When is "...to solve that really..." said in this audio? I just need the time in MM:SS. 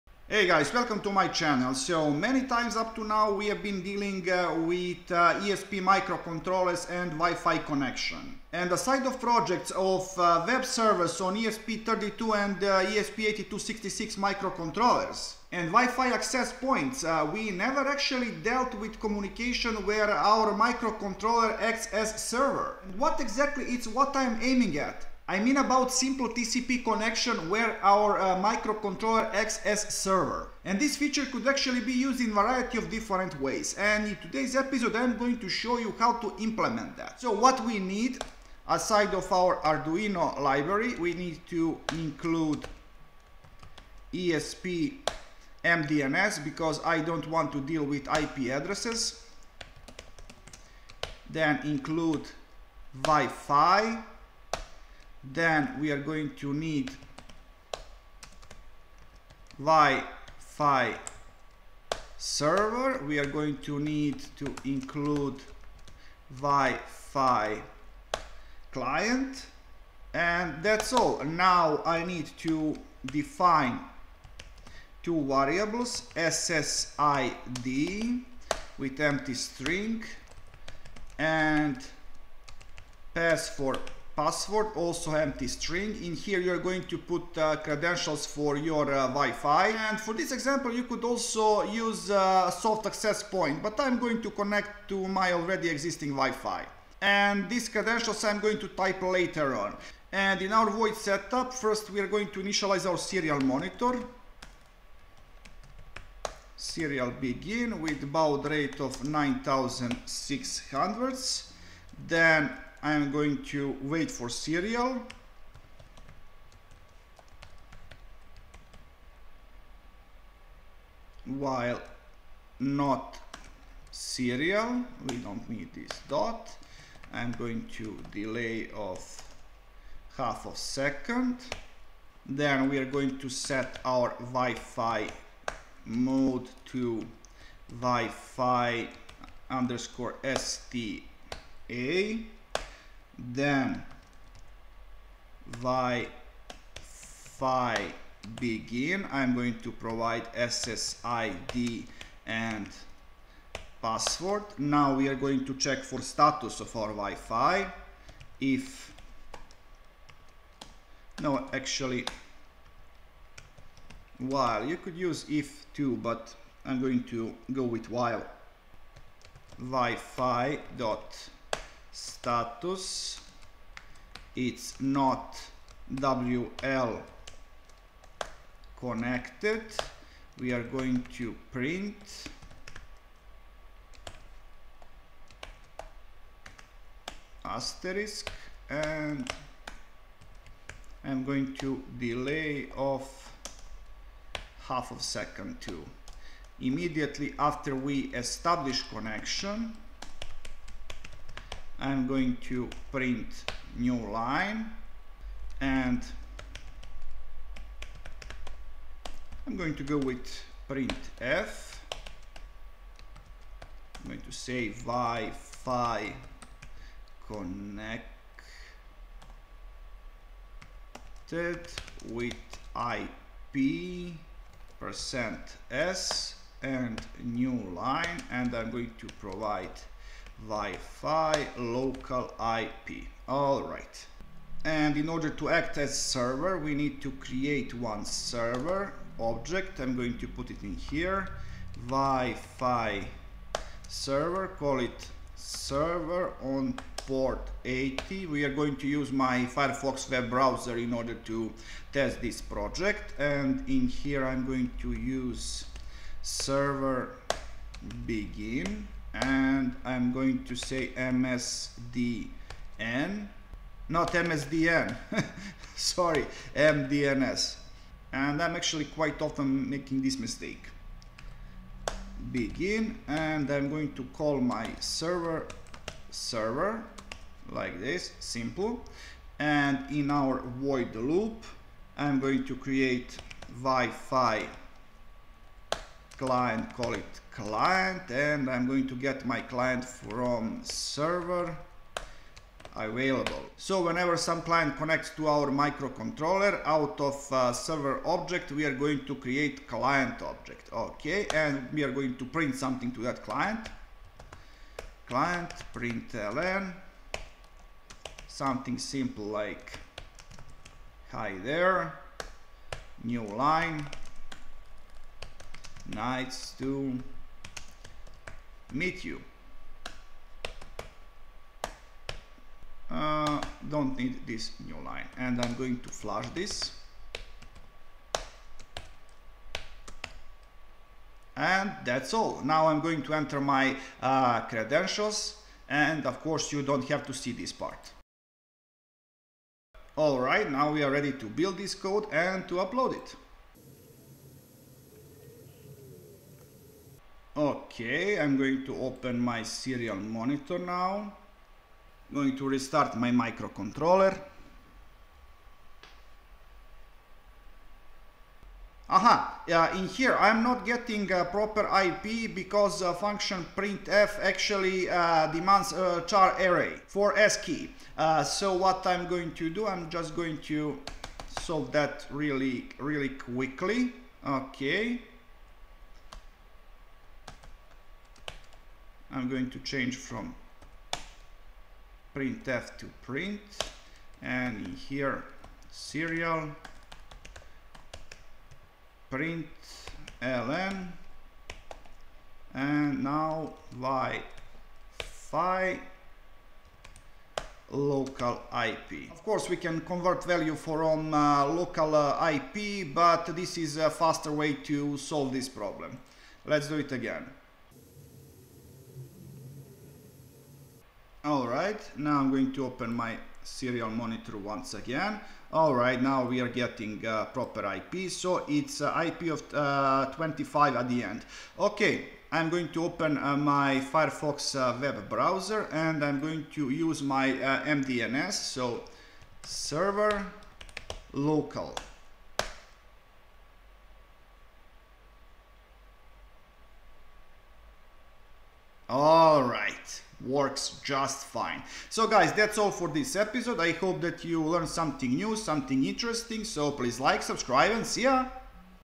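06:10.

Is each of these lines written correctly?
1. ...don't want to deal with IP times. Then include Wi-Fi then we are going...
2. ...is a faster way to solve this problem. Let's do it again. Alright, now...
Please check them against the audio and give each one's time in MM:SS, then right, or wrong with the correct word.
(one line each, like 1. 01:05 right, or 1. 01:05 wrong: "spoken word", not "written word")
1. 00:46 wrong: "addresses", not "times"
2. 06:43 right.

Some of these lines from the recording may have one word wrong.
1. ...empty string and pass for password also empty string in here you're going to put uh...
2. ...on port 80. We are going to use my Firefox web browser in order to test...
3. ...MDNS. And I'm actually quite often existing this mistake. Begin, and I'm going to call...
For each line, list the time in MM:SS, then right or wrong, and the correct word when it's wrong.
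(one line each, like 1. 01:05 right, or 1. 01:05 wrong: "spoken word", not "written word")
1. 01:18 right
2. 04:06 right
3. 04:26 wrong: "making", not "existing".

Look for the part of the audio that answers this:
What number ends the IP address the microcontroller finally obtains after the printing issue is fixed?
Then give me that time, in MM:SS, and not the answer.
07:00.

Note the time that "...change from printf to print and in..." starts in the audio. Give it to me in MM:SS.
06:19.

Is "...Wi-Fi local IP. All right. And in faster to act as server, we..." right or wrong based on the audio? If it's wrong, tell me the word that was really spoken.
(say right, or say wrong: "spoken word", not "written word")
wrong: "order", not "faster".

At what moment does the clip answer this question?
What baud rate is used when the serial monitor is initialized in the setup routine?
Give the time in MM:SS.
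01:49.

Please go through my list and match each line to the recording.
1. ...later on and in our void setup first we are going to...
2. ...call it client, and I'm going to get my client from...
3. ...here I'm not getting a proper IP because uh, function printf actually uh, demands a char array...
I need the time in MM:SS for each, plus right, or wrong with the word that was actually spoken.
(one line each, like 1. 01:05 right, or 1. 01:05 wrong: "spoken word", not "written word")
1. 01:39 right
2. 04:46 right
3. 05:59 right.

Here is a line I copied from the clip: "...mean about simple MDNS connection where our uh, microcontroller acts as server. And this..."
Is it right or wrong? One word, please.
wrong.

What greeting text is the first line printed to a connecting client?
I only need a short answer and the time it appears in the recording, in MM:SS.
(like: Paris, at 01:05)
hi there, at 05:11.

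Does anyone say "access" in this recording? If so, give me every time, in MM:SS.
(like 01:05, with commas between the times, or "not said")
00:16, 01:32.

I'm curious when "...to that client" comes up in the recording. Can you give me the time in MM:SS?
05:02.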